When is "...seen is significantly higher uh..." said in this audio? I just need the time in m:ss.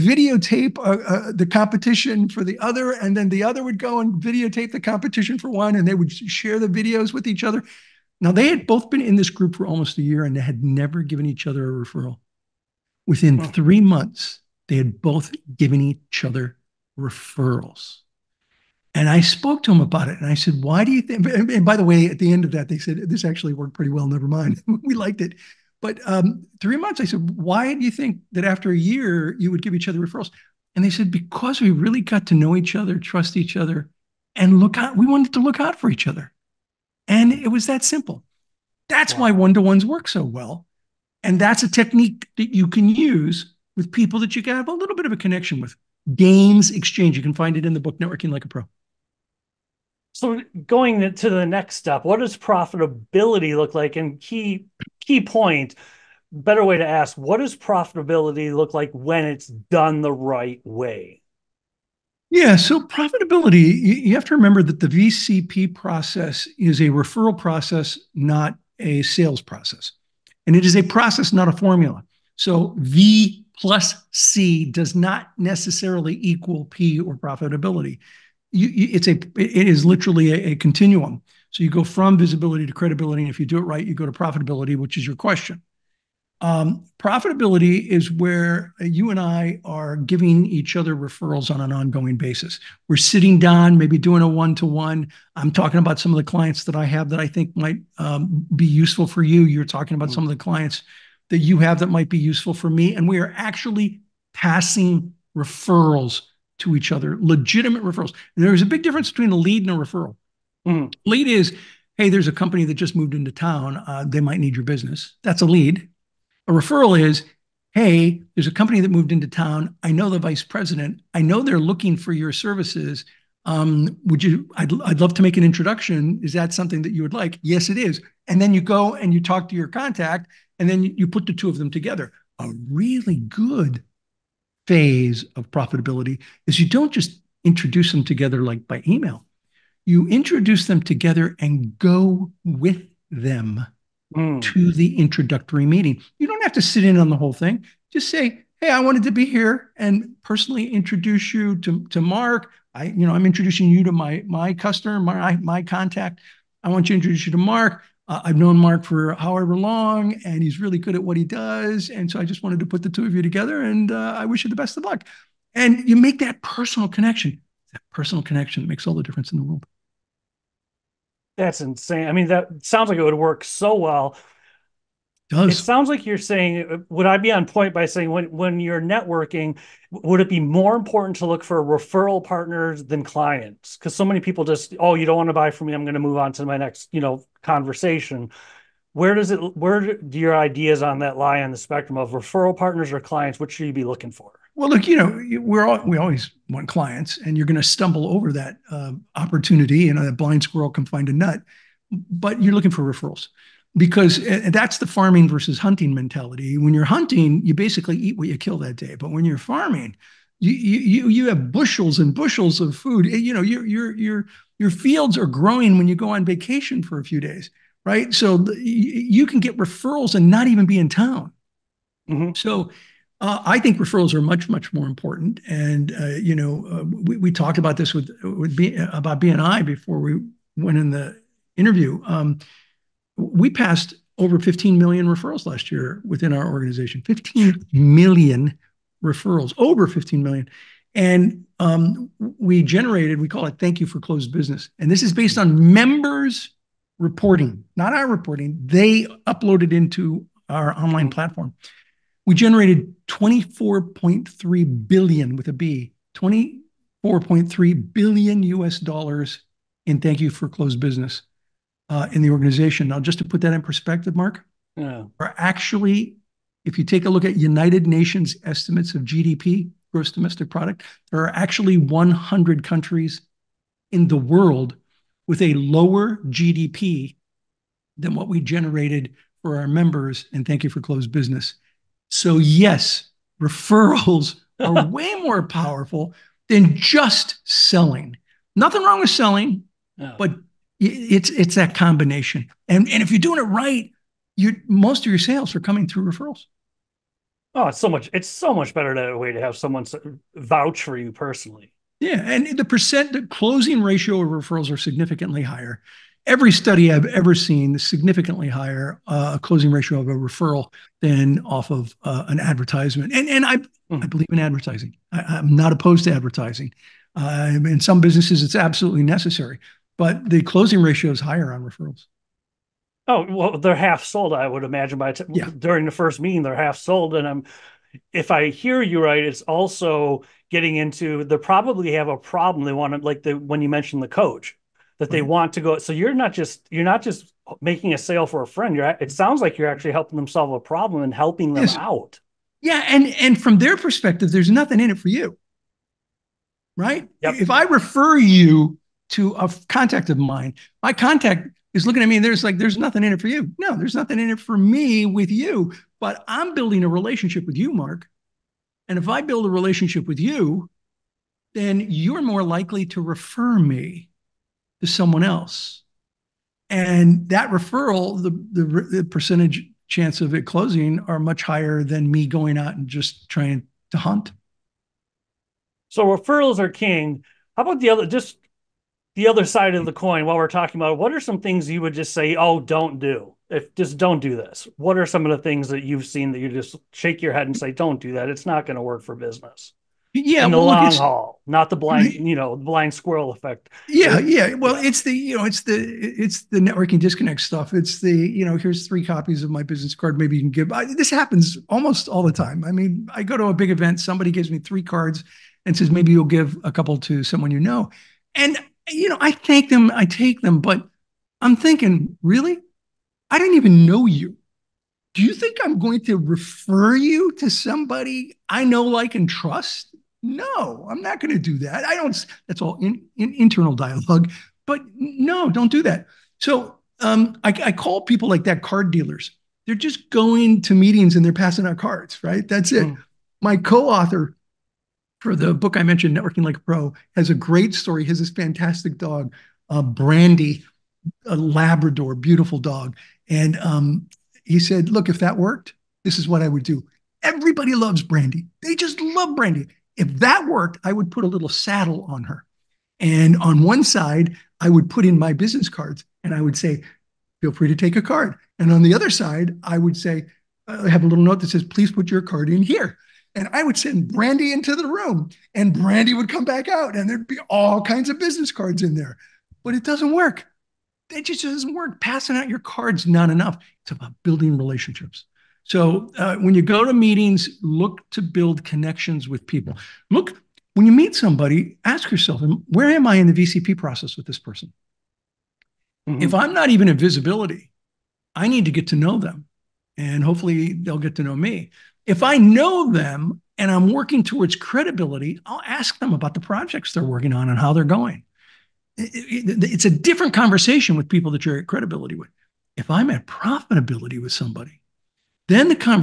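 5:07.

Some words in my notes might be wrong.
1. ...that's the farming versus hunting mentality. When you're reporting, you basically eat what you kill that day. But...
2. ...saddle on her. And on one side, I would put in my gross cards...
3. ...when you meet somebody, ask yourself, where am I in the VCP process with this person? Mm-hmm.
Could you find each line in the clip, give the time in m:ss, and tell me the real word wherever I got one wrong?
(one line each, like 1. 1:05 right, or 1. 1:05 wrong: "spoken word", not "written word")
1. 3:24 wrong: "hunting", not "reporting"
2. 7:31 wrong: "business", not "gross"
3. 8:00 right.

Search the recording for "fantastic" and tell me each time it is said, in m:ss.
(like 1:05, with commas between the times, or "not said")
7:18.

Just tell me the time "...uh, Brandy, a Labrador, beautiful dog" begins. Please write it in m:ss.
7:19.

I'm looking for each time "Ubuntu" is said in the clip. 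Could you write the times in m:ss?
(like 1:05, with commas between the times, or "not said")
not said.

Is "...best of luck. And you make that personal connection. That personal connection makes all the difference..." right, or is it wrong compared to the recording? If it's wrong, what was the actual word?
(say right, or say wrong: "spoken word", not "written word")
right.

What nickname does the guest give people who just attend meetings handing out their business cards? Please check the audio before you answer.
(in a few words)
Card dealers.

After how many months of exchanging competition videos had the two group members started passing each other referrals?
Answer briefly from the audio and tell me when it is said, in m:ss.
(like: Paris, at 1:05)
3, at 0:13.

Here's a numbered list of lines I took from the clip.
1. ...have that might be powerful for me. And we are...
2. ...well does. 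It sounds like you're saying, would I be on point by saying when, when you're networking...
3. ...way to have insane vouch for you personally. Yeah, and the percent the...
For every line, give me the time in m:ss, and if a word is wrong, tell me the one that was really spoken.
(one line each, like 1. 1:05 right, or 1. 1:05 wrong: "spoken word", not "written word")
1. 1:41 wrong: "useful", not "powerful"
2. 2:53 right
3. 4:59 wrong: "someone", not "insane".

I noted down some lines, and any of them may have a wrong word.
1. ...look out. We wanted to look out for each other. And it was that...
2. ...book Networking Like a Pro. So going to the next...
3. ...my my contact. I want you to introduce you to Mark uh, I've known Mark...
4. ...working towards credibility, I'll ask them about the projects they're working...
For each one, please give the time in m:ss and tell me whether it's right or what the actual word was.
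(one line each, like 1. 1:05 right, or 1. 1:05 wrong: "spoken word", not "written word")
1. 0:34 right
2. 0:47 right
3. 2:34 right
4. 8:13 right.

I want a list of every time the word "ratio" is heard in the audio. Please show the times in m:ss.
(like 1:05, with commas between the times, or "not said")
5:03, 5:09, 5:20.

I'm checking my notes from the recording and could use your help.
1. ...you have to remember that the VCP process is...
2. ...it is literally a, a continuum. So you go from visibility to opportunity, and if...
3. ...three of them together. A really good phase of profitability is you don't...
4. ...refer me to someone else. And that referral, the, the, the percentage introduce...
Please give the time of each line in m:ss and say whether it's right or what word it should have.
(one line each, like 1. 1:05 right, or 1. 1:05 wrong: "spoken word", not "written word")
1. 1:04 right
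2. 1:19 wrong: "credibility", not "opportunity"
3. 2:11 wrong: "two", not "three"
4. 6:03 wrong: "chance", not "introduce".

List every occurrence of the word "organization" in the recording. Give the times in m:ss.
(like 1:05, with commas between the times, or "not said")
3:56, 4:22.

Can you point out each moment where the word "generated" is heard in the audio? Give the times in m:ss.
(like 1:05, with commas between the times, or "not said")
4:02, 4:12, 4:38.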